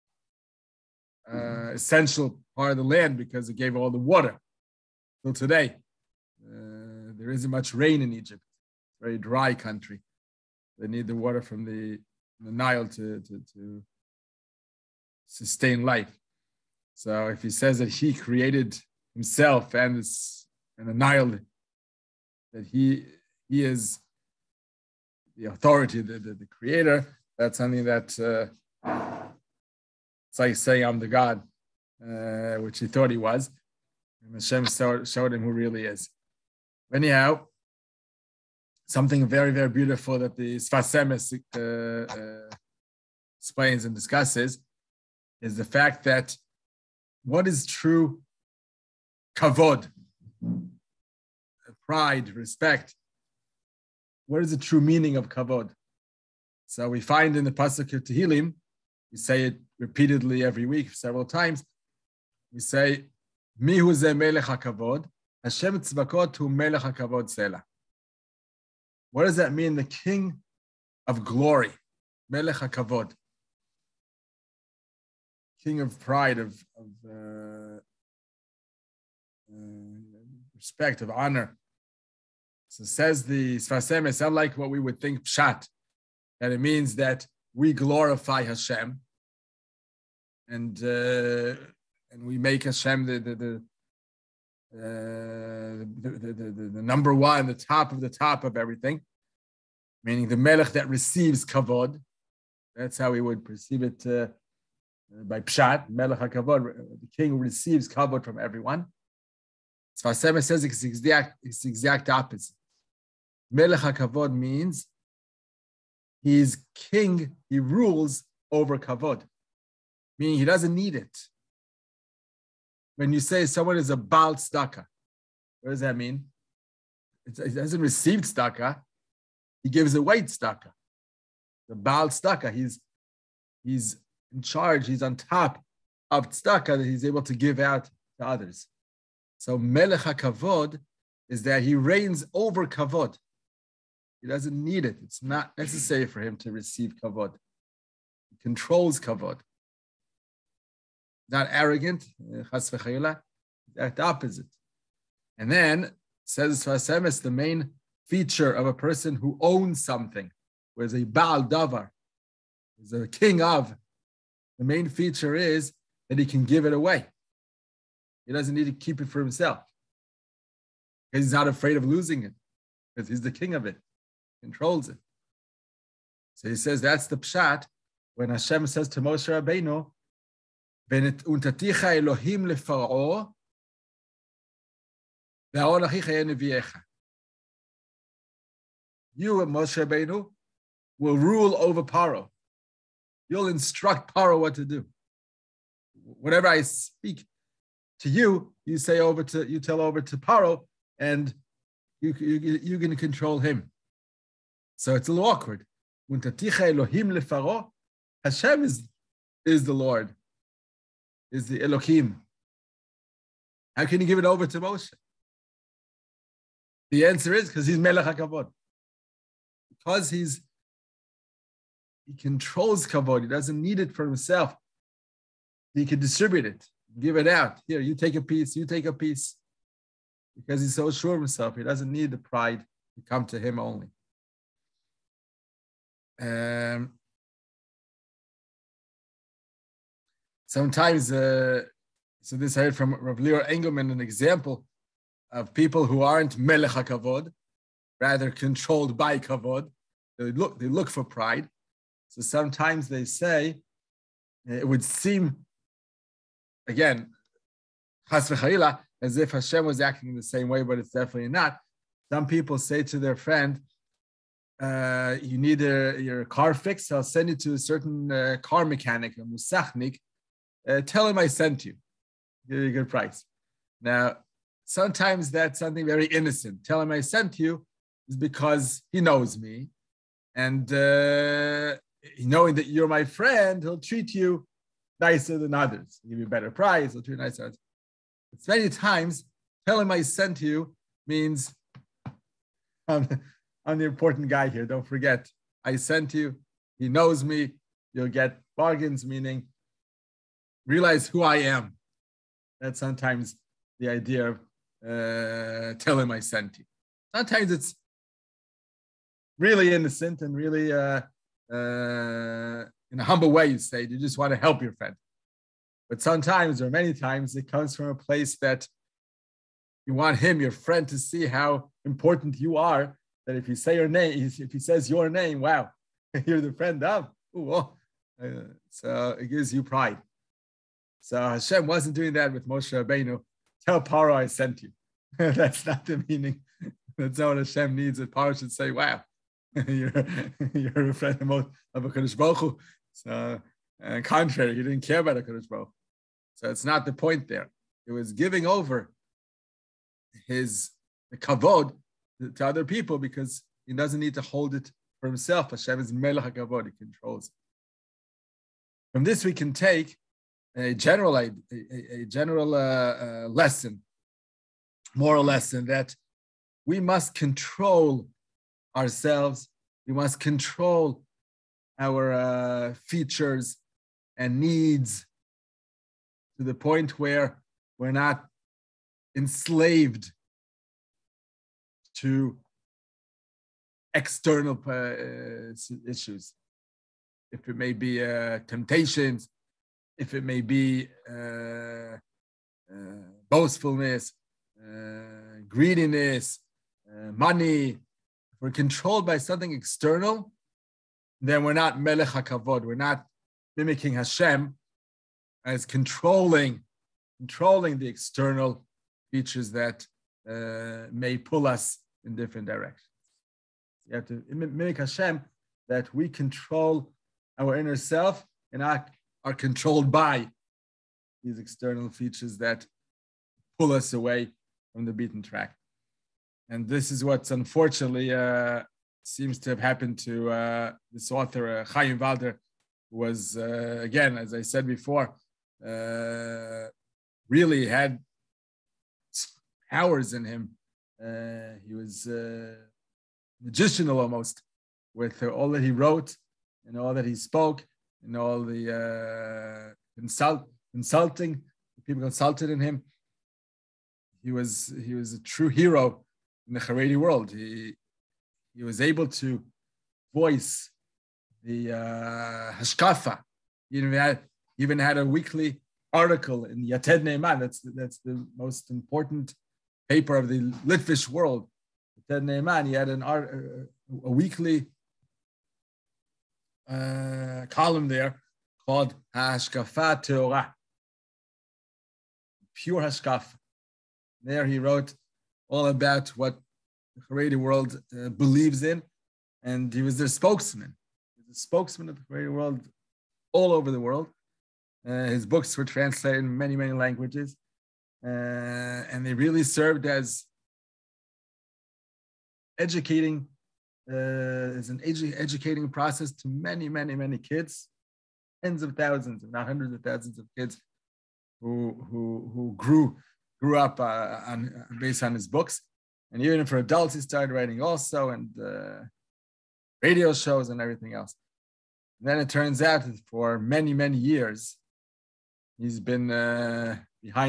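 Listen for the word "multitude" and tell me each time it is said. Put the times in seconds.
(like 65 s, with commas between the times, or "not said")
not said.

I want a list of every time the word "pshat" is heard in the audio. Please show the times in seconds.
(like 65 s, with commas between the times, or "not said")
85 s, 105 s, 177 s.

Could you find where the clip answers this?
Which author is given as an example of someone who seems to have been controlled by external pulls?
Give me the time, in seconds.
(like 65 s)
431 s.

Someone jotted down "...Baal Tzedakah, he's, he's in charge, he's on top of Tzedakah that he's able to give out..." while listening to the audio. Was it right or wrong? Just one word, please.
right.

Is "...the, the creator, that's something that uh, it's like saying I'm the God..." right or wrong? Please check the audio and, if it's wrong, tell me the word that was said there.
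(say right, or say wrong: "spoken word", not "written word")
right.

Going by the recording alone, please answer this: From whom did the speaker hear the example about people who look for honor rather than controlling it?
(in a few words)
Rav Lior Engelman.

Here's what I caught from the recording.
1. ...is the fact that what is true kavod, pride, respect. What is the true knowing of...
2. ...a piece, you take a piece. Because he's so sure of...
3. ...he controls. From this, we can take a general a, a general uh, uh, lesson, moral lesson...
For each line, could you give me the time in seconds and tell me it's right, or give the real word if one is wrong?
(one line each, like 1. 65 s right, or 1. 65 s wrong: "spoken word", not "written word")
1. 45 s wrong: "meaning", not "knowing"
2. 228 s right
3. 356 s right.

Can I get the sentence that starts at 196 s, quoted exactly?
Whatever I speak to you, you say over to you tell over to Paro, and you you you can control him.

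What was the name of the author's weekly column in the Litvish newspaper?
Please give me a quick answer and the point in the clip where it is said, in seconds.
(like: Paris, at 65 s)
Hashkafat Torah, at 479 s.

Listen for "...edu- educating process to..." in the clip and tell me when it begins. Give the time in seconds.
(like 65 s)
504 s.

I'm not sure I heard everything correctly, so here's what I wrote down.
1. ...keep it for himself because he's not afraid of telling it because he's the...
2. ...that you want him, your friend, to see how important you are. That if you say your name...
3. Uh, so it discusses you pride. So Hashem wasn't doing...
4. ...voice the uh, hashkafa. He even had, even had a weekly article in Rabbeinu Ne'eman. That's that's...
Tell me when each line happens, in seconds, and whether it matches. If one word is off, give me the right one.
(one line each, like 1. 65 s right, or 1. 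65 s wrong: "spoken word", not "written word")
1. 168 s wrong: "losing", not "telling"
2. 318 s right
3. 328 s wrong: "gives", not "discusses"
4. 460 s wrong: "Yated", not "Rabbeinu".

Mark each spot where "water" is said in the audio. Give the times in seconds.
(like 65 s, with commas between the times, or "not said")
3 s, 11 s.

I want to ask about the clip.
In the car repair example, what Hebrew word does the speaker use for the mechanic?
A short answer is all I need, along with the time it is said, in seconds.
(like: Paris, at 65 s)
musachnik, at 269 s.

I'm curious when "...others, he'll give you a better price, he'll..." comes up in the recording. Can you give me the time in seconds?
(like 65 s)
285 s.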